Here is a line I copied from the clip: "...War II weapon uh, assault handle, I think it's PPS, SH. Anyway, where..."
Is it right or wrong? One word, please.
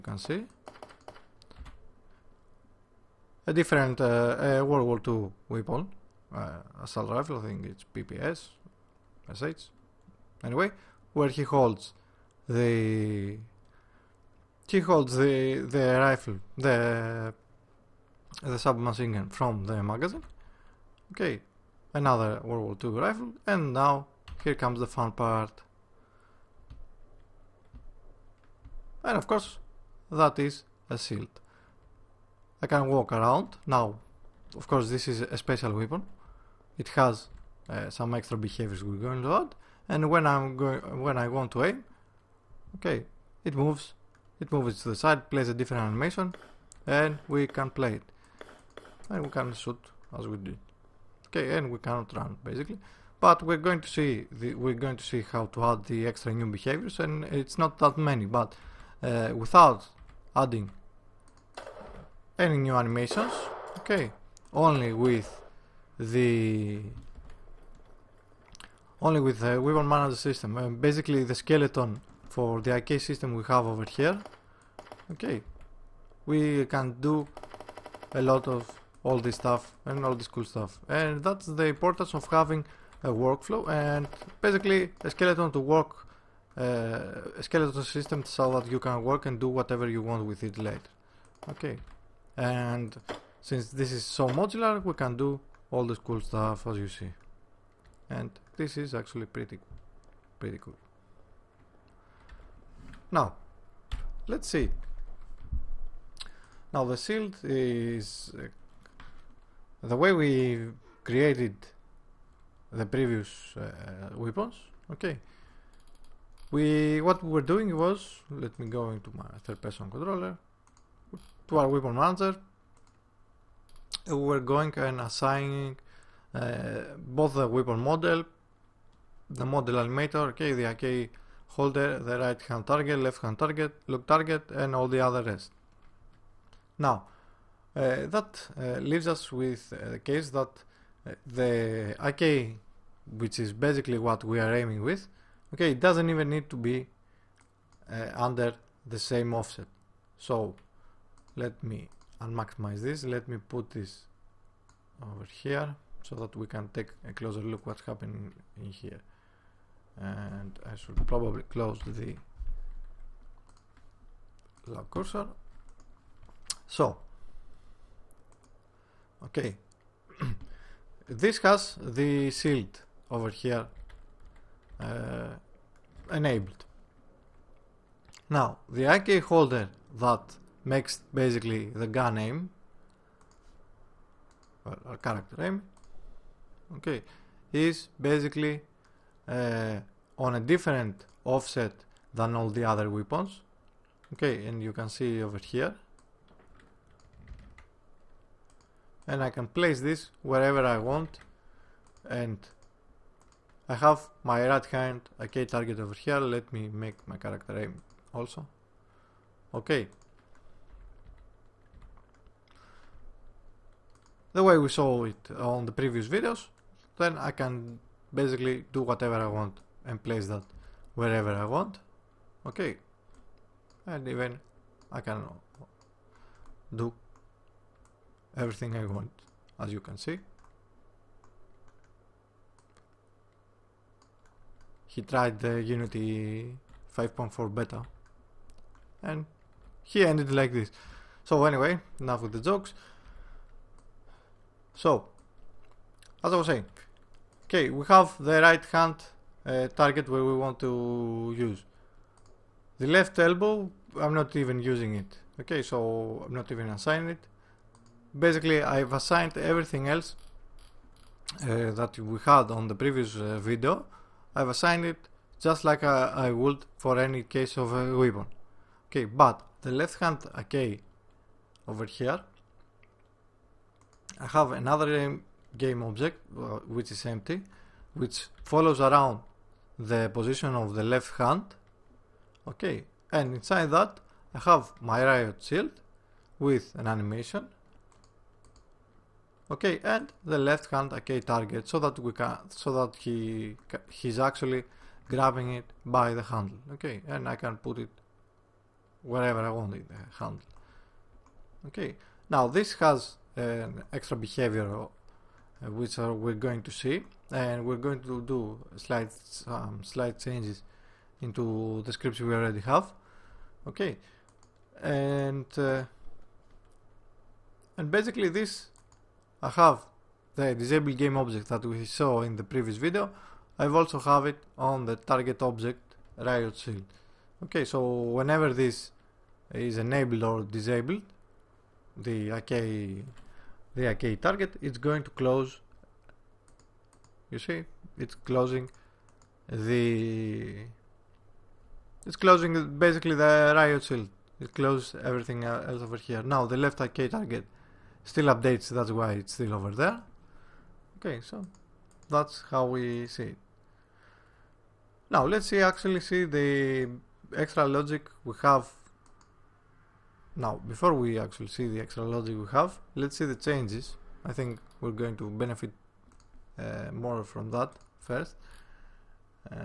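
wrong.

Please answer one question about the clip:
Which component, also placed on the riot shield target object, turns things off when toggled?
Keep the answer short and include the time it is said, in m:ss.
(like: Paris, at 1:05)
Disable game object, at 5:20.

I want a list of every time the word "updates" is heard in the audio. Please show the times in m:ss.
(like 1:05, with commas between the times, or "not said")
5:48.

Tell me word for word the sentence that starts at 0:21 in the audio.
Okay, another World War II rifle, and now here comes the fun part.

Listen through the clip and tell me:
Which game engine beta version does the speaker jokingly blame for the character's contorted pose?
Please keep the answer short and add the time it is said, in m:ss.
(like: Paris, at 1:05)
Unity 5.4 beta, at 3:55.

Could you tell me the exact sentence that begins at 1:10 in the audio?
Um, basically, the skeleton for the IK system we have over here.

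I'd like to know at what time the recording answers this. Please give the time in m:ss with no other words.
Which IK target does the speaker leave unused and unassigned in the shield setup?
4:12.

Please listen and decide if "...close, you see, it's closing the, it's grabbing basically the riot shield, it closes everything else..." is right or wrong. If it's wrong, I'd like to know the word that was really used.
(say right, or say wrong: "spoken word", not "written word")
wrong: "closing", not "grabbing".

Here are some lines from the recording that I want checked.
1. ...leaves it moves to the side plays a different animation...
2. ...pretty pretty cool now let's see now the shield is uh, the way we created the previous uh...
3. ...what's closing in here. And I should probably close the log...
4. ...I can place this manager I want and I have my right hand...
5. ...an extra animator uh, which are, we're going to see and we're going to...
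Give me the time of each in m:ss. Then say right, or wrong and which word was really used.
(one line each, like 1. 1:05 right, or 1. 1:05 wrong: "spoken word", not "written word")
1. 0:43 wrong: "moves", not "leaves"
2. 1:39 right
3. 2:37 wrong: "happening", not "closing"
4. 3:19 wrong: "wherever", not "manager"
5. 5:03 wrong: "behavior", not "animator".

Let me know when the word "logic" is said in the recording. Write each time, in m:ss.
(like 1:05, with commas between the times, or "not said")
5:57, 6:02.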